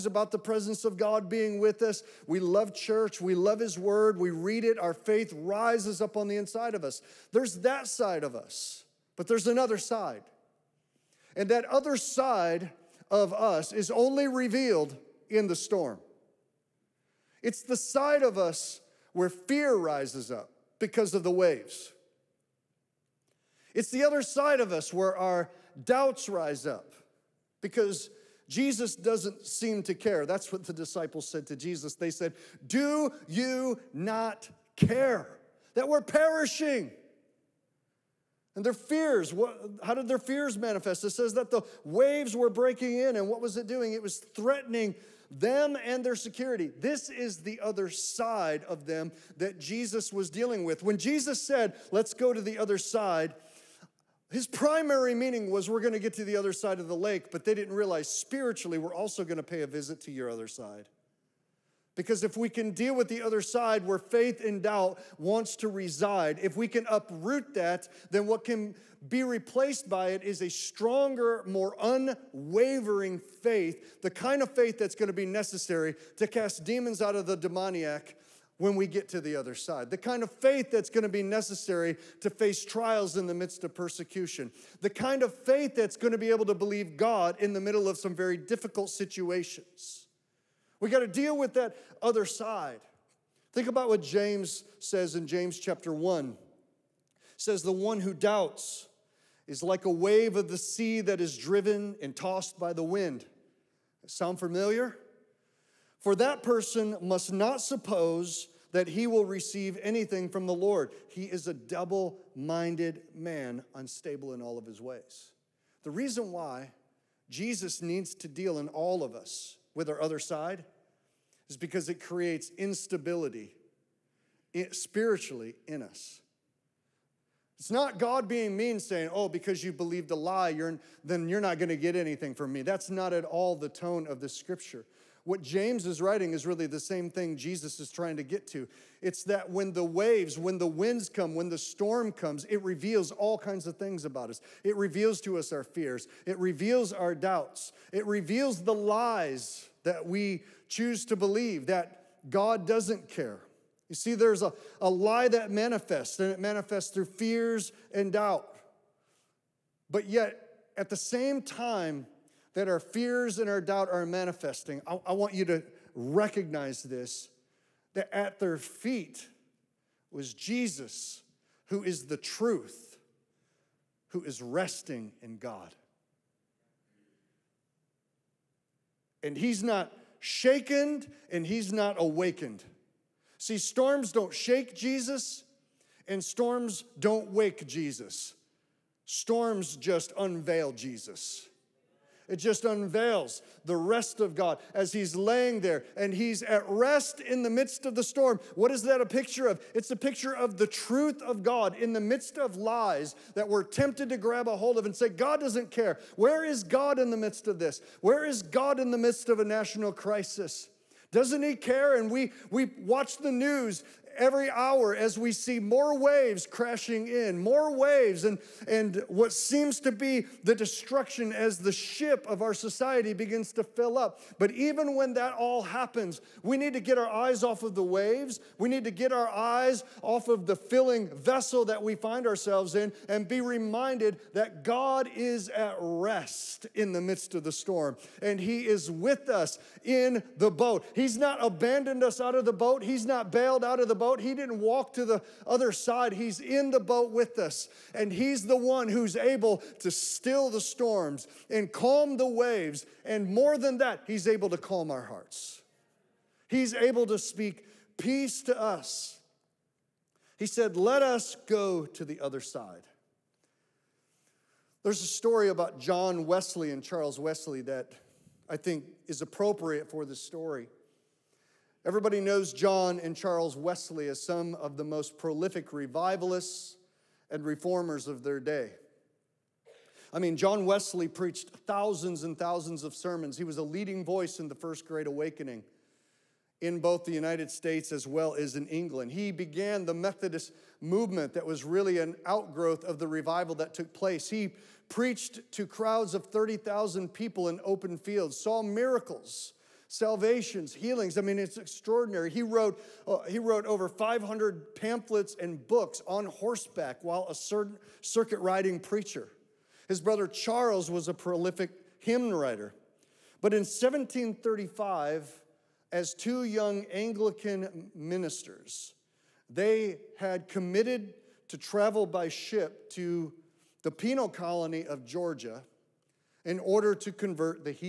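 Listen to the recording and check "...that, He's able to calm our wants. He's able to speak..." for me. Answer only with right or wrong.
wrong.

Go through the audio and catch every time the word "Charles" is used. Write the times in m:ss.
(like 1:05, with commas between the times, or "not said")
4:26, 4:33, 5:10.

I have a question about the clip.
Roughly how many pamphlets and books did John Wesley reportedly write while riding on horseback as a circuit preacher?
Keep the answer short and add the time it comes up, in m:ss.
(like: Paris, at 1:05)
over 500, at 5:03.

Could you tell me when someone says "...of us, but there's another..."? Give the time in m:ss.
0:08.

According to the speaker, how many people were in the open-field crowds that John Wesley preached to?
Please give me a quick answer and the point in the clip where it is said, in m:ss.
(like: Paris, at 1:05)
30,000, at 4:56.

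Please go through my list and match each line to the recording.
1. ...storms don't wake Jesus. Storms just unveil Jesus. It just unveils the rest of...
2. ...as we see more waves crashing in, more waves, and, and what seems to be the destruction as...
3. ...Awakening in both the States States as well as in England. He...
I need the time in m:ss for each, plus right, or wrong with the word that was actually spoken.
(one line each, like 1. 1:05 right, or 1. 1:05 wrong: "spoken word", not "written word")
1. 3:06 right
2. 3:34 right
3. 4:45 wrong: "United", not "States".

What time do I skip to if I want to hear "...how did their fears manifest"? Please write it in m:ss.
0:39.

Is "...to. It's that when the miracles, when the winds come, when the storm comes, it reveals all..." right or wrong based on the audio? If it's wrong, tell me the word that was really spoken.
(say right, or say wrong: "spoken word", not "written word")
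wrong: "waves", not "miracles".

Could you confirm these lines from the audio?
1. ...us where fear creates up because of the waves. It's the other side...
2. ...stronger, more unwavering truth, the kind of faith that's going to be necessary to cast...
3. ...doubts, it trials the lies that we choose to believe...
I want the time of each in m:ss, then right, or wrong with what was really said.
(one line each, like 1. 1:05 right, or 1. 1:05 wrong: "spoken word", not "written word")
1. 0:18 wrong: "rises", not "creates"
2. 1:10 wrong: "faith", not "truth"
3. 2:27 wrong: "reveals", not "trials".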